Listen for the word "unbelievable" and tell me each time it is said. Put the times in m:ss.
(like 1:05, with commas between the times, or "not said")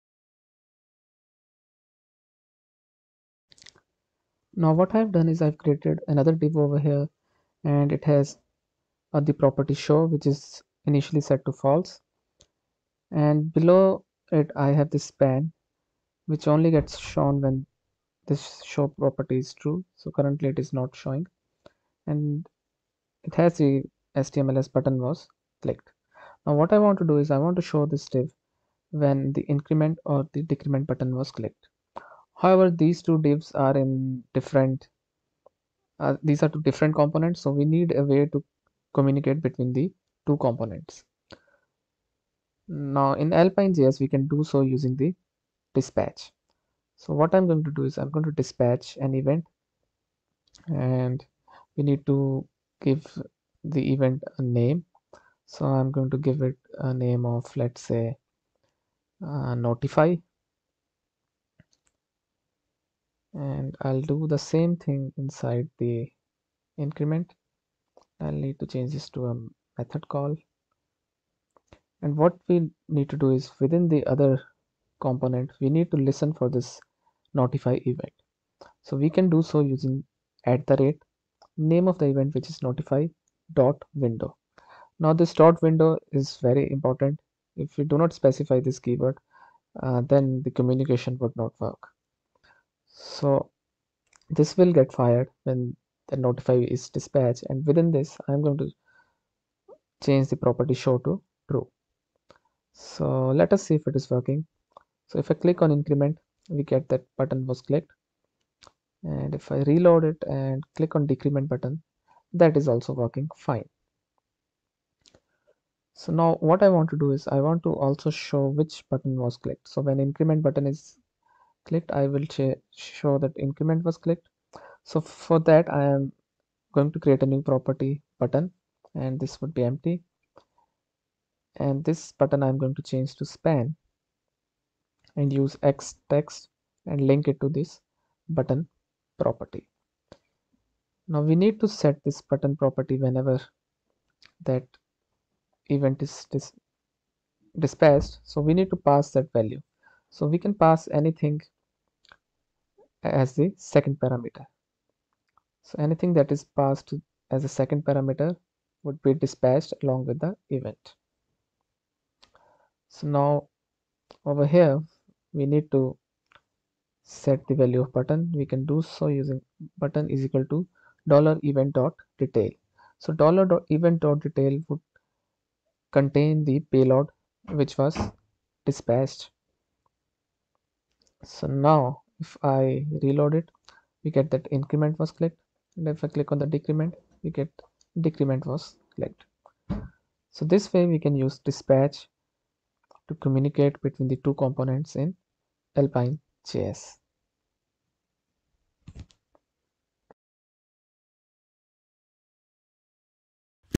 not said.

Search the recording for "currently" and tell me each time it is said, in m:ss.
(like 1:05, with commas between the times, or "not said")
0:20.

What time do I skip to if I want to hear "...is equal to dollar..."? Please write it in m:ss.
2:50.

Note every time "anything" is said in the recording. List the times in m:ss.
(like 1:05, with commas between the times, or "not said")
2:31, 2:35.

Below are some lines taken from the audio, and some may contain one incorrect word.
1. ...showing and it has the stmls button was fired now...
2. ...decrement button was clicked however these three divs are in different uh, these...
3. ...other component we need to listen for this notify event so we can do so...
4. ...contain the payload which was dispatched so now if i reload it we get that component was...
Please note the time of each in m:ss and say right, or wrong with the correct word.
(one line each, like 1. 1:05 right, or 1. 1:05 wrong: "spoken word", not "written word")
1. 0:20 wrong: "clicked", not "fired"
2. 0:30 wrong: "two", not "three"
3. 1:14 right
4. 2:55 wrong: "increment", not "component".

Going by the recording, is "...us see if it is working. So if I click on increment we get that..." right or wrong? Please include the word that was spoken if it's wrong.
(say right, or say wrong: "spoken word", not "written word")
right.